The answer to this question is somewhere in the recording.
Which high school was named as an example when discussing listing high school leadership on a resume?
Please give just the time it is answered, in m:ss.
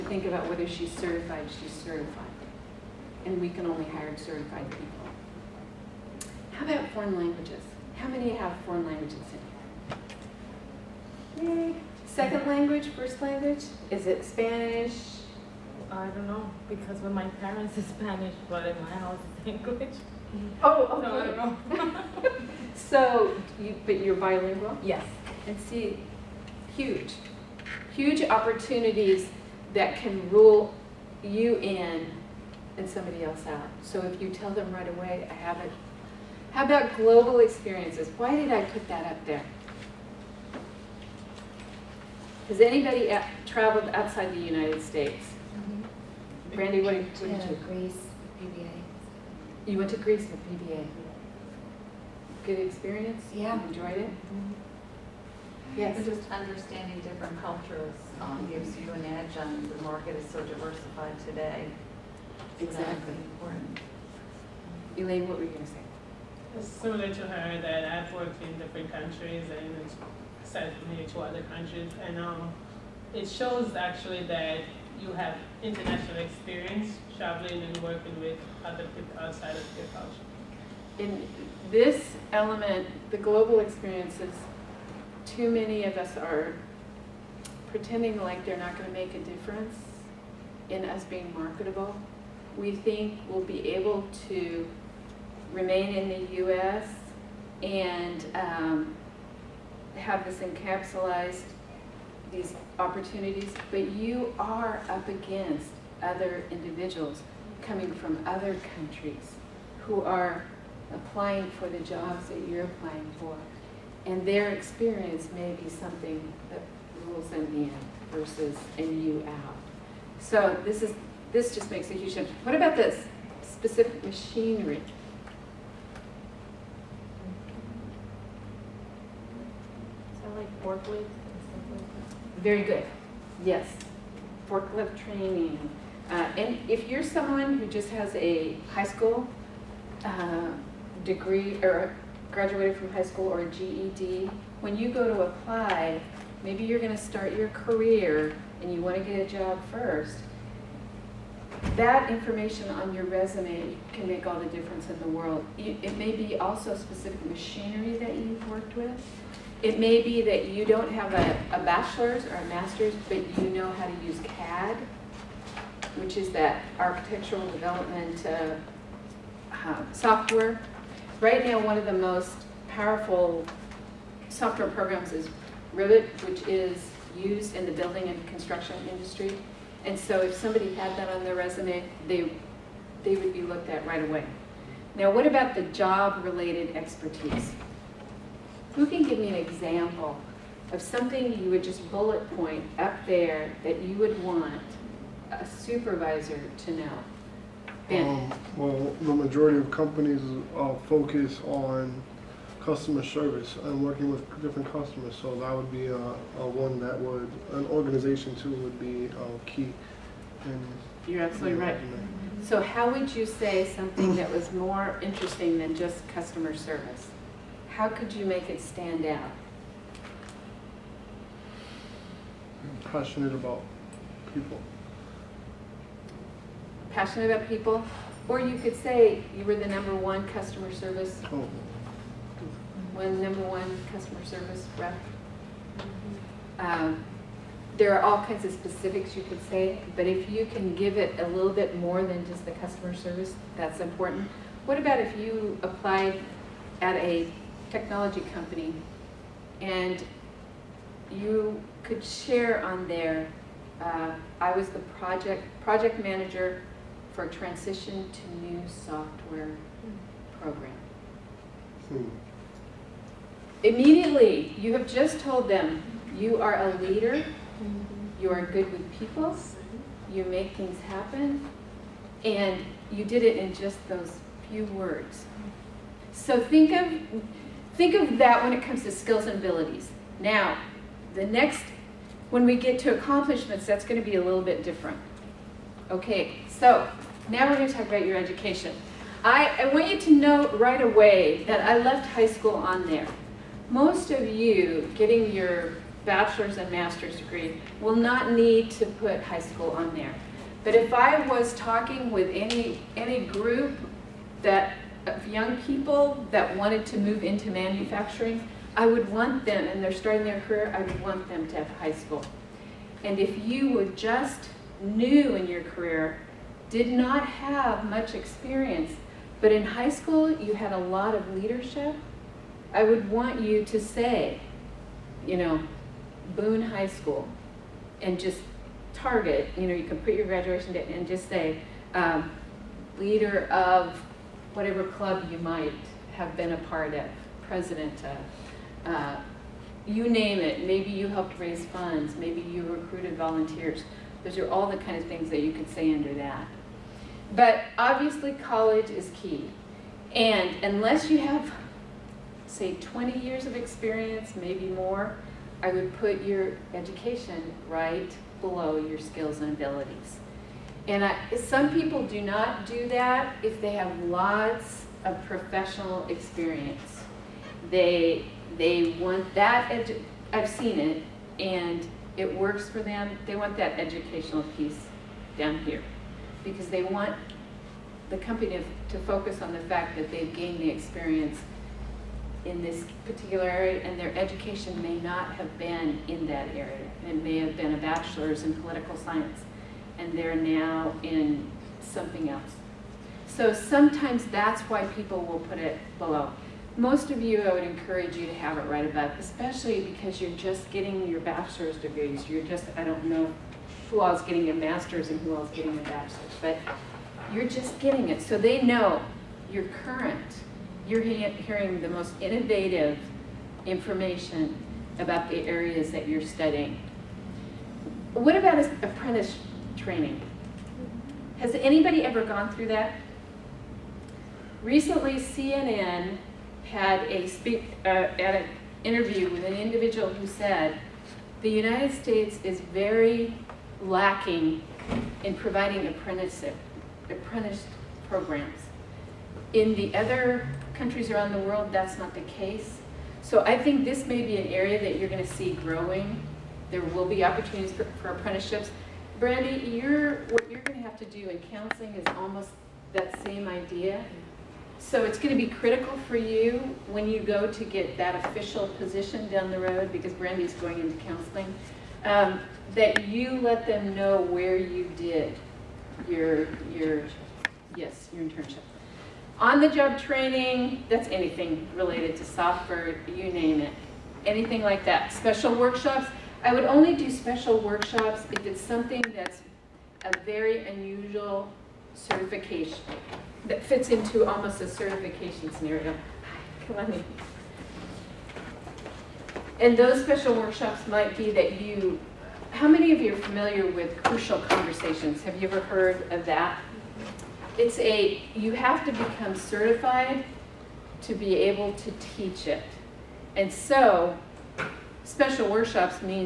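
5:26.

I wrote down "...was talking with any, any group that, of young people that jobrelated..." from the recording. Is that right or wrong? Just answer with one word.
wrong.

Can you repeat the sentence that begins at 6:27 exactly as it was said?
It may have been a bachelor's in political science and they're now in something else.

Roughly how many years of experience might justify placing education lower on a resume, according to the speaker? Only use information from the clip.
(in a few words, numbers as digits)
20 years.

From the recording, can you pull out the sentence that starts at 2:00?
So this is this just makes a huge difference.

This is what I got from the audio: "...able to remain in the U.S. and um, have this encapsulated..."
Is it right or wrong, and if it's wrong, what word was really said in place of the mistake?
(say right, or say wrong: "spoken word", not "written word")
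right.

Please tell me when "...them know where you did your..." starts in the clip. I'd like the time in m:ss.
7:43.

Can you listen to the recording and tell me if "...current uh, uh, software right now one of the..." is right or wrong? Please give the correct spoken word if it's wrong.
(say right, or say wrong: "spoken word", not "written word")
wrong: "development", not "current".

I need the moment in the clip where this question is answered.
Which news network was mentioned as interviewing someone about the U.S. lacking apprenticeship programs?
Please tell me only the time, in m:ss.
7:05.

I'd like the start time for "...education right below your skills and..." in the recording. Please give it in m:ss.
5:56.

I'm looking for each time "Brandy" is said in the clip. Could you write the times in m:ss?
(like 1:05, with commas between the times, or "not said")
0:46, 7:29, 7:40.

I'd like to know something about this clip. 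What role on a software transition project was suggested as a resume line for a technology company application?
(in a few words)
Project manager.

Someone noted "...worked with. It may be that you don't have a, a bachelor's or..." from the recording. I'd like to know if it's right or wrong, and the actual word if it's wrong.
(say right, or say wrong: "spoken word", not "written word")
right.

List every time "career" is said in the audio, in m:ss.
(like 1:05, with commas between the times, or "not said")
2:27, 5:10, 5:15.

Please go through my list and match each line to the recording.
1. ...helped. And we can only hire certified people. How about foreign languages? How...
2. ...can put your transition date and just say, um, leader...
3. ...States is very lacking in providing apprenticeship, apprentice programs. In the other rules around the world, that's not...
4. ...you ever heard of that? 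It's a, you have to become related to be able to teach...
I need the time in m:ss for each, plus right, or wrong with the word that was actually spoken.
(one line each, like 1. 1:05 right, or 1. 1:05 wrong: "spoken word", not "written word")
1. 0:01 wrong: "certified", not "helped"
2. 5:29 wrong: "graduation", not "transition"
3. 7:11 wrong: "countries", not "rules"
4. 8:15 wrong: "certified", not "related".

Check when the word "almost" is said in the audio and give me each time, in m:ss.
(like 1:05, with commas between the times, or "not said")
7:32, 8:04.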